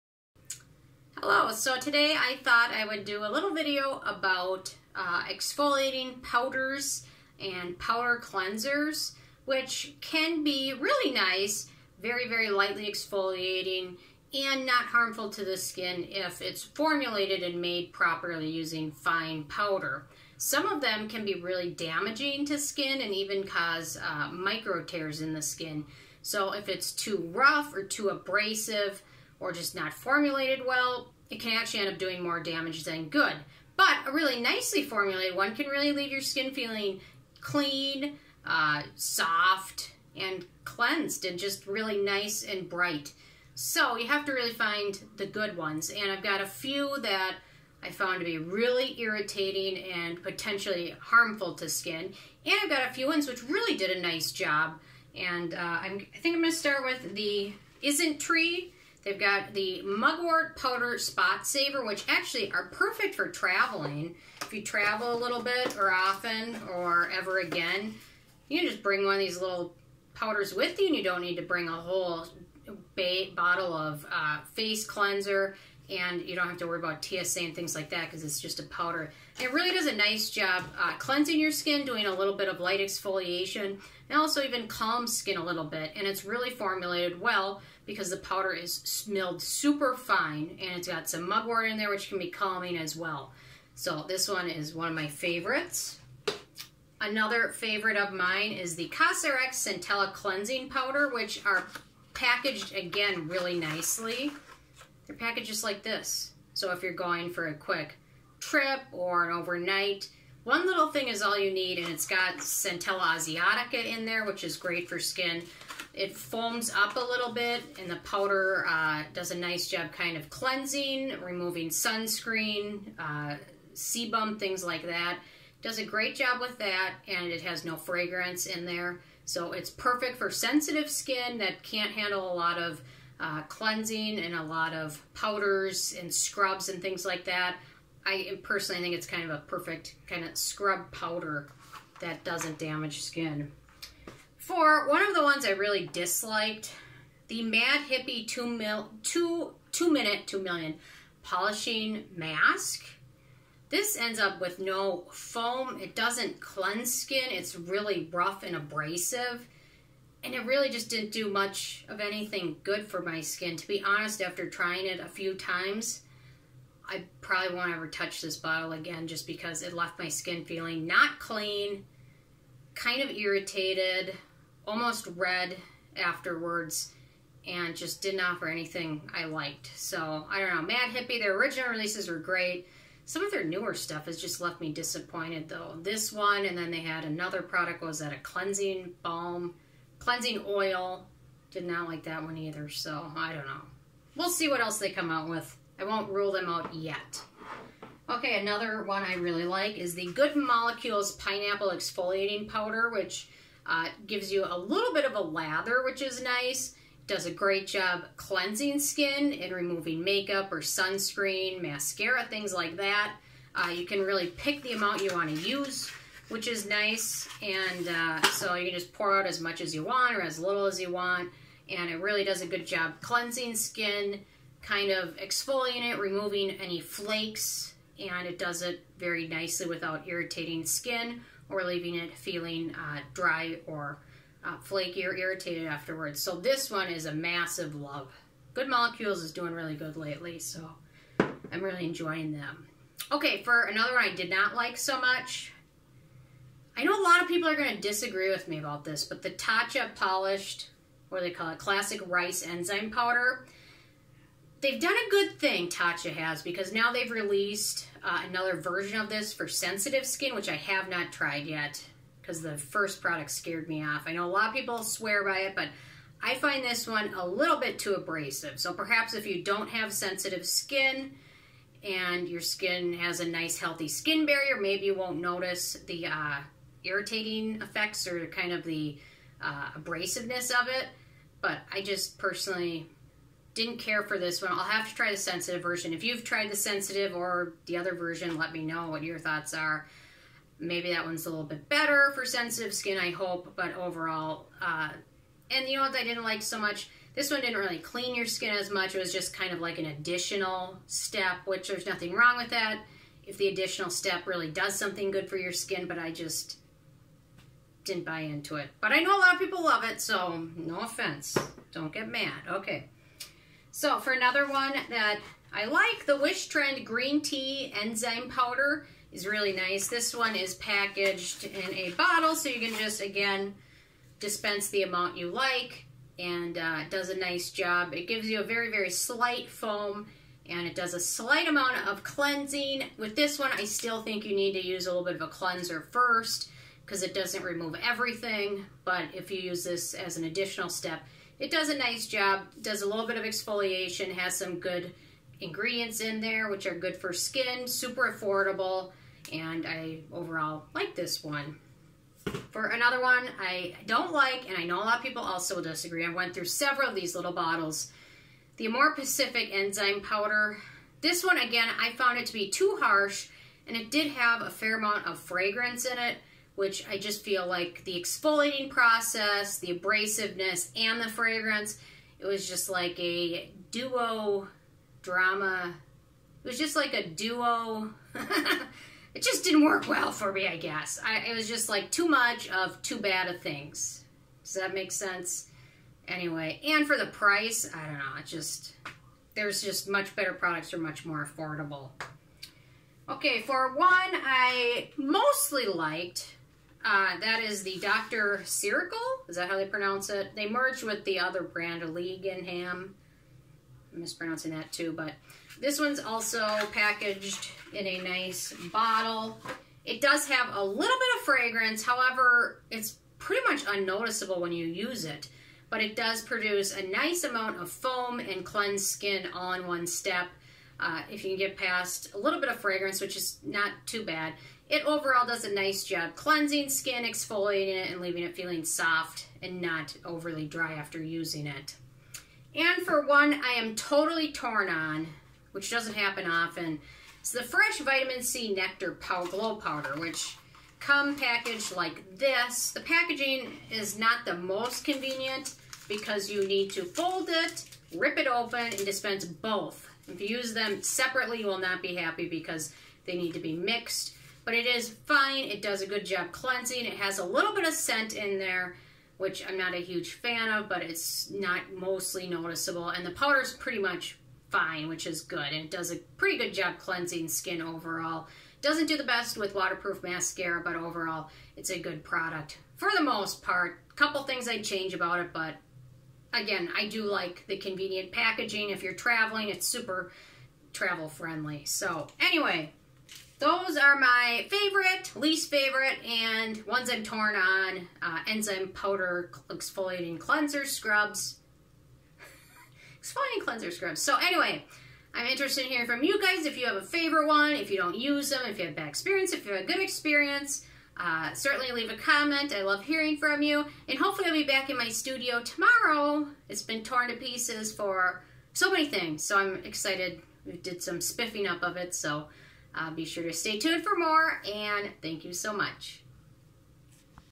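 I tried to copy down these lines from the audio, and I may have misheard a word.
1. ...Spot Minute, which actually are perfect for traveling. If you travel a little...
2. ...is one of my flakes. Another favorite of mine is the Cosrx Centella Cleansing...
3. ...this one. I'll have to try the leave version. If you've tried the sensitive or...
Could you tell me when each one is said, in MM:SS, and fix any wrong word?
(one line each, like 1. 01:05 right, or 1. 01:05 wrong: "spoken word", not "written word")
1. 01:00 wrong: "Saver", not "Minute"
2. 01:34 wrong: "favorites", not "flakes"
3. 04:44 wrong: "sensitive", not "leave".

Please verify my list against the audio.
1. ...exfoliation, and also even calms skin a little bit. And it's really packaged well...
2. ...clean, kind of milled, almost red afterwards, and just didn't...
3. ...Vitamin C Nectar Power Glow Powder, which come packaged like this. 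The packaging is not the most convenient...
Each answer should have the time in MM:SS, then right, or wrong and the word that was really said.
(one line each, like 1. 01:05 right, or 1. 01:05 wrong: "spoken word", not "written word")
1. 01:22 wrong: "formulated", not "packaged"
2. 02:51 wrong: "irritated", not "milled"
3. 07:17 right.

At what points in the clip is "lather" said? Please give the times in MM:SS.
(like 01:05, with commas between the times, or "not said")
03:25.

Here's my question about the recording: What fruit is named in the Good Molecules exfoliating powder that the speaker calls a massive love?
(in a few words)
Pineapple.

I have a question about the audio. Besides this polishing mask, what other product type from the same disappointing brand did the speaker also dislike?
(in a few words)
Cleansing oil.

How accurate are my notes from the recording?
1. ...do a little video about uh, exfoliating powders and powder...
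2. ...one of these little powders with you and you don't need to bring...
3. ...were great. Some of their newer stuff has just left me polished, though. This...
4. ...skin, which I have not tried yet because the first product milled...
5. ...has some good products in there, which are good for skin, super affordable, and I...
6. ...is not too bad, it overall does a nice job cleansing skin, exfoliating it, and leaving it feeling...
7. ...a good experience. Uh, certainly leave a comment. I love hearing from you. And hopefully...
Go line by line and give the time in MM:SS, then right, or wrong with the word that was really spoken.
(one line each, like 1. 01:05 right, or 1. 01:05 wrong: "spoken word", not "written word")
1. 00:03 right
2. 01:09 right
3. 03:02 wrong: "disappointed", not "polished"
4. 04:20 wrong: "scared", not "milled"
5. 05:44 wrong: "ingredients", not "products"
6. 07:03 right
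7. 08:19 right.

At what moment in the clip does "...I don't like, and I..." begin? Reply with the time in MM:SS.
05:53.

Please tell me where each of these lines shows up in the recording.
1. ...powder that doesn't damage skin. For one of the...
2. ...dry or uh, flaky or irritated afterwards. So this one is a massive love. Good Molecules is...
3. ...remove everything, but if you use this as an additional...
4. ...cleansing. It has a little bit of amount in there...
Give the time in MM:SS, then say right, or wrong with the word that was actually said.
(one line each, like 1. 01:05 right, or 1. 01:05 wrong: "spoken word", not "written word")
1. 02:20 right
2. 03:53 right
3. 05:37 right
4. 07:36 wrong: "scent", not "amount".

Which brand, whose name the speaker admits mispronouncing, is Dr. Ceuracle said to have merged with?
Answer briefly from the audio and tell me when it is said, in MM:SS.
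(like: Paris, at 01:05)
League and Ham, at 06:41.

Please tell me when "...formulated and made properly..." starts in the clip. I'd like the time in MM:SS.
00:16.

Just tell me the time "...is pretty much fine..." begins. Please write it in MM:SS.
07:43.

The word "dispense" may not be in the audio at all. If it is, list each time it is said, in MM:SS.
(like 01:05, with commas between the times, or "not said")
05:24, 07:28.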